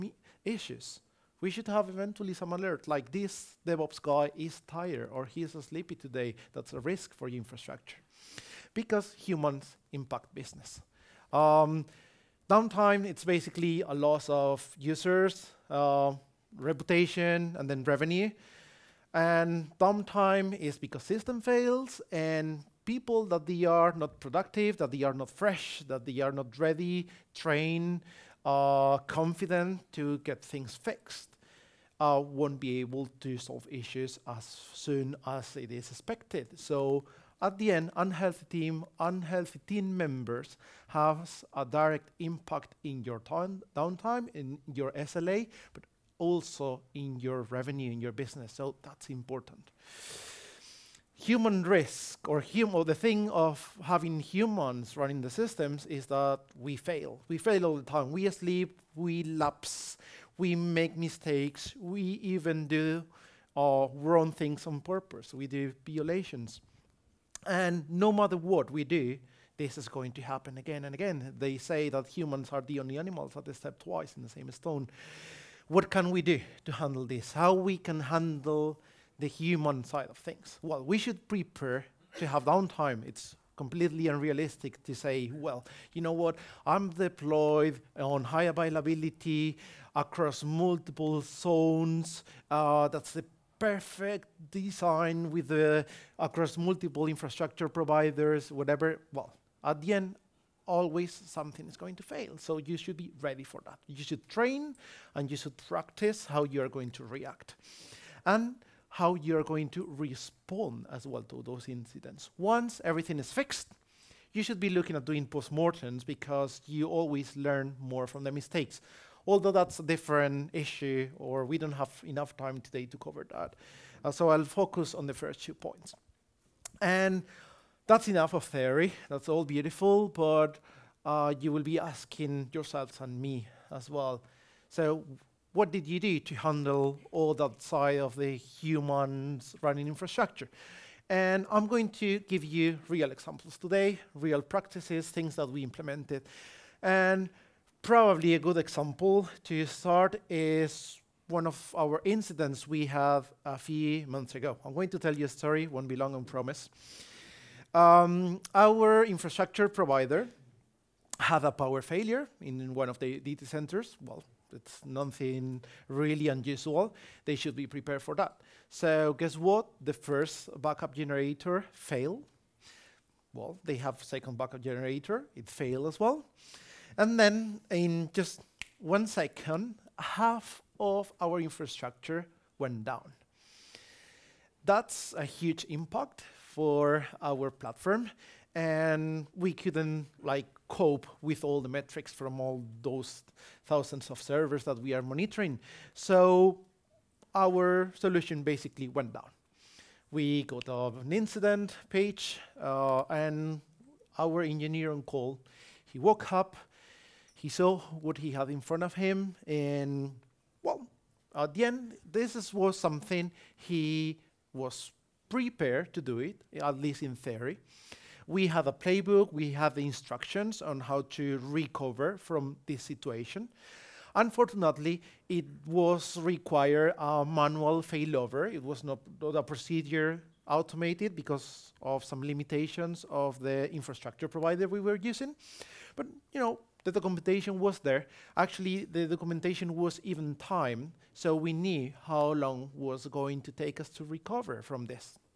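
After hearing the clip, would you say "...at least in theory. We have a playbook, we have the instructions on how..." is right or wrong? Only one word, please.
right.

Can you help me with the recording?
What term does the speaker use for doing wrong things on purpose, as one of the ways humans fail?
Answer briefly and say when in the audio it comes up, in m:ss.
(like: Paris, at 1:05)
Violations, at 1:05.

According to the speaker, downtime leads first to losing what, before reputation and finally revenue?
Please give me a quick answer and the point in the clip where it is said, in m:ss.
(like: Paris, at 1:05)
Users, at 0:14.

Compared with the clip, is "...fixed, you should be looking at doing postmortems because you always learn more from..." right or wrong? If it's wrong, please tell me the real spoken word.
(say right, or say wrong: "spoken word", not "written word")
right.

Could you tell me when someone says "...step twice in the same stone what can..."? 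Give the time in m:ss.
1:13.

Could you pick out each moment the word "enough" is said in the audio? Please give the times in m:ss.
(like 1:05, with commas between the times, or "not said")
2:02, 2:08.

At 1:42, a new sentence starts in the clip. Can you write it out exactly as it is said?
So you should be ready for that.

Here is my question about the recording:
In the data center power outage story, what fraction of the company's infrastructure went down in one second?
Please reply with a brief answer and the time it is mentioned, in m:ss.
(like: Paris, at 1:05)
Half, at 2:59.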